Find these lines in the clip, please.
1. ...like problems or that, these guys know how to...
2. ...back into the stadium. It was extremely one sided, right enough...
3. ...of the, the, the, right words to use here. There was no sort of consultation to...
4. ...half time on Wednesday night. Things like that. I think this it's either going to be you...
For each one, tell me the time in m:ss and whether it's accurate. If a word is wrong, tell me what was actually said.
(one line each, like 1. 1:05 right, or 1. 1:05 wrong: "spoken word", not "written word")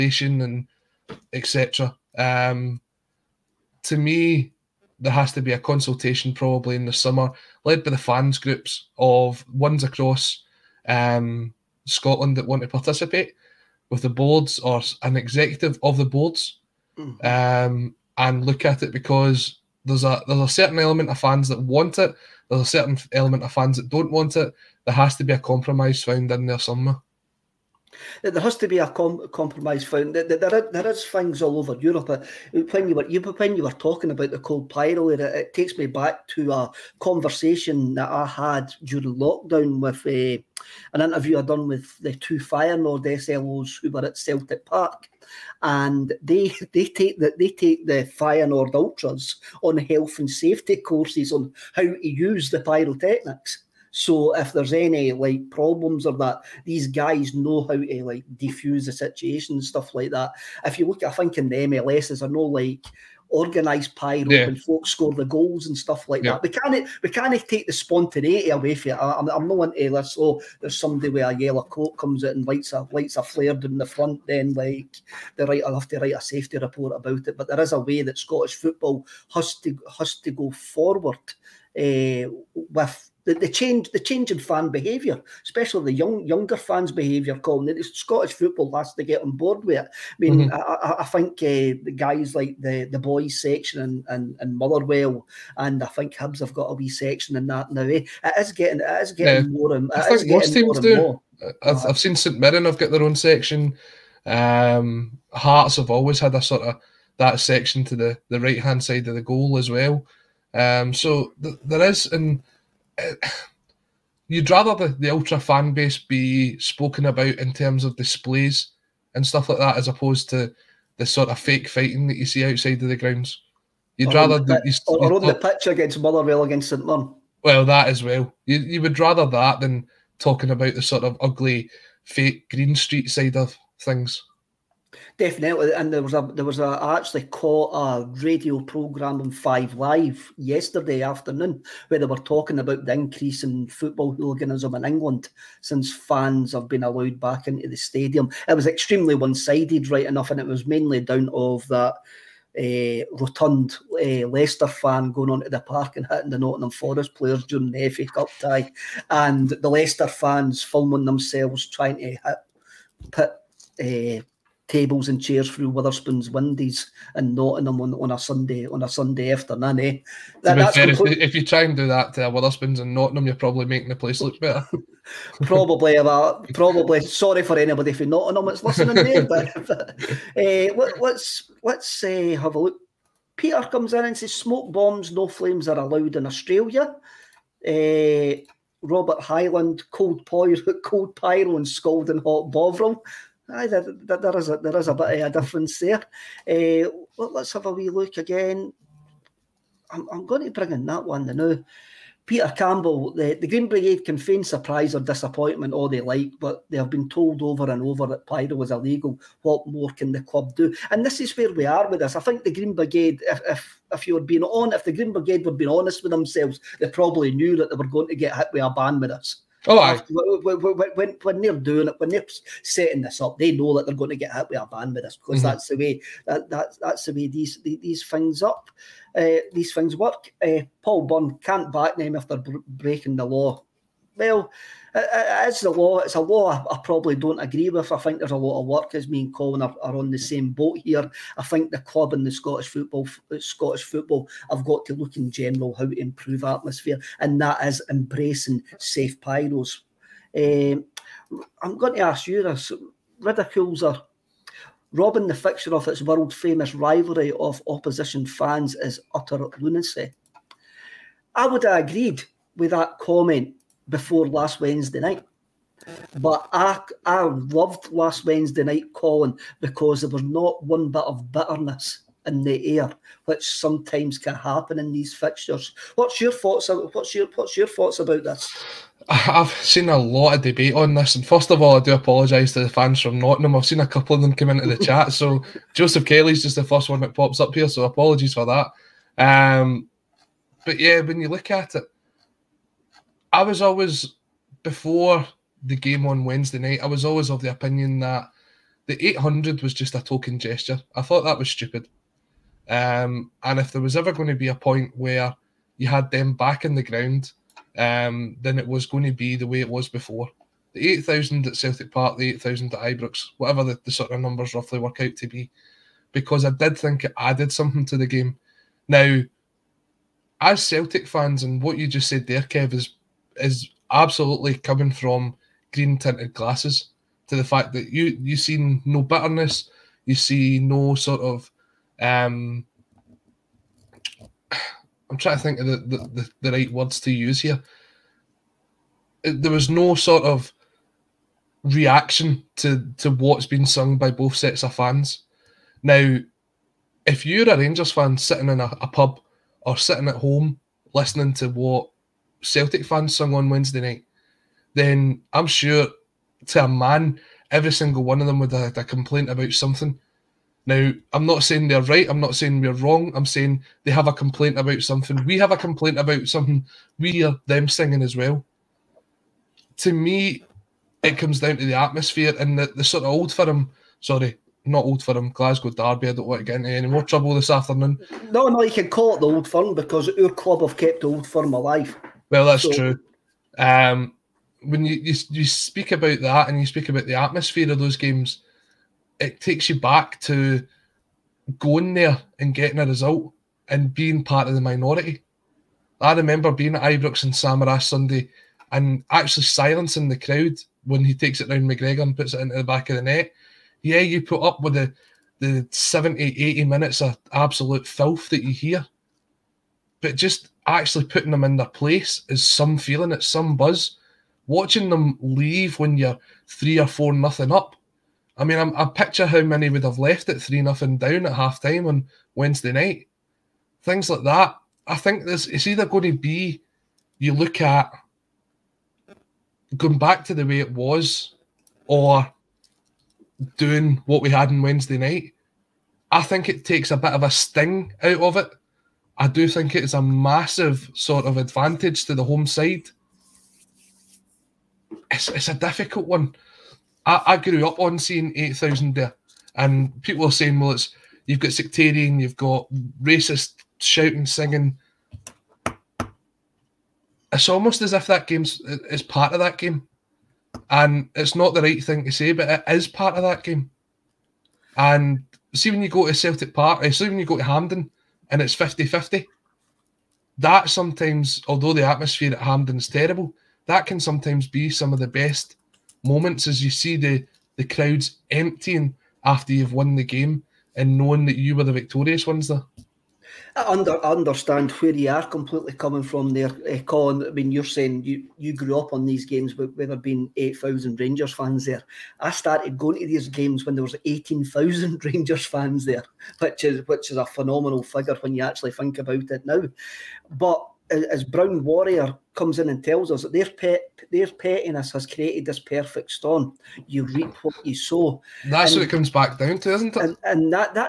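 1. 0:55 right
2. 2:27 right
3. 5:35 wrong: "reaction", not "consultation"
4. 7:01 right.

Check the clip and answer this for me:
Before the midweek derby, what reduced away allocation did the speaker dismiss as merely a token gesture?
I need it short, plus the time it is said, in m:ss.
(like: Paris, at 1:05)
800, at 4:59.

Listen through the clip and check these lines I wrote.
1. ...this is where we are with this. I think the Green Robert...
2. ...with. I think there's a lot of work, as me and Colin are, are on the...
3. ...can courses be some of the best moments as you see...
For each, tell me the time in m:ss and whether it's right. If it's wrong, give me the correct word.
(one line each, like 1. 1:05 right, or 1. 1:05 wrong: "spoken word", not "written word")
1. 3:31 wrong: "Brigade", not "Robert"
2. 3:57 right
3. 7:53 wrong: "sometimes", not "courses".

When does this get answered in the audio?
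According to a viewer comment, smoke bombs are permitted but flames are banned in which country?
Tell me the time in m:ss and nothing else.
3:06.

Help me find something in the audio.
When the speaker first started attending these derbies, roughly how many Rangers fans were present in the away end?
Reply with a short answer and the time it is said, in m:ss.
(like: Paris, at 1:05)
18,000, at 8:14.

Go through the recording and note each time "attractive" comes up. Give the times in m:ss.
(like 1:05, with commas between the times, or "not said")
not said.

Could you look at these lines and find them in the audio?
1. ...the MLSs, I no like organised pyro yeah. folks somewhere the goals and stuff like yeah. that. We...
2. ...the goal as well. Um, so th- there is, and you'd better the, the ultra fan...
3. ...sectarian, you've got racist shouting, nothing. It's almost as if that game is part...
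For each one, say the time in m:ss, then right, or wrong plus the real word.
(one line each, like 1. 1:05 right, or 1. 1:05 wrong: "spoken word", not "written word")
1. 1:01 wrong: "score", not "somewhere"
2. 1:49 wrong: "rather", not "better"
3. 7:31 wrong: "singing", not "nothing".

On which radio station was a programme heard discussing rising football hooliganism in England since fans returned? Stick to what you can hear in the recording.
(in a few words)
Five Live.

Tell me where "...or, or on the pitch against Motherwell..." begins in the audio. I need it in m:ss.
2:04.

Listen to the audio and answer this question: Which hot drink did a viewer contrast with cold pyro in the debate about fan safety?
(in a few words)
Bovril.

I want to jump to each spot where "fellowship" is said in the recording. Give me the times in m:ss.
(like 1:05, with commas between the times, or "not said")
not said.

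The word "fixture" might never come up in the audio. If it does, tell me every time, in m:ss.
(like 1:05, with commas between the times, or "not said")
4:15, 4:35.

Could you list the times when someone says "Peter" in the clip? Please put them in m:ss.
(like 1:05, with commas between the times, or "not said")
3:03, 3:22.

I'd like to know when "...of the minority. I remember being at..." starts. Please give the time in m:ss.
6:34.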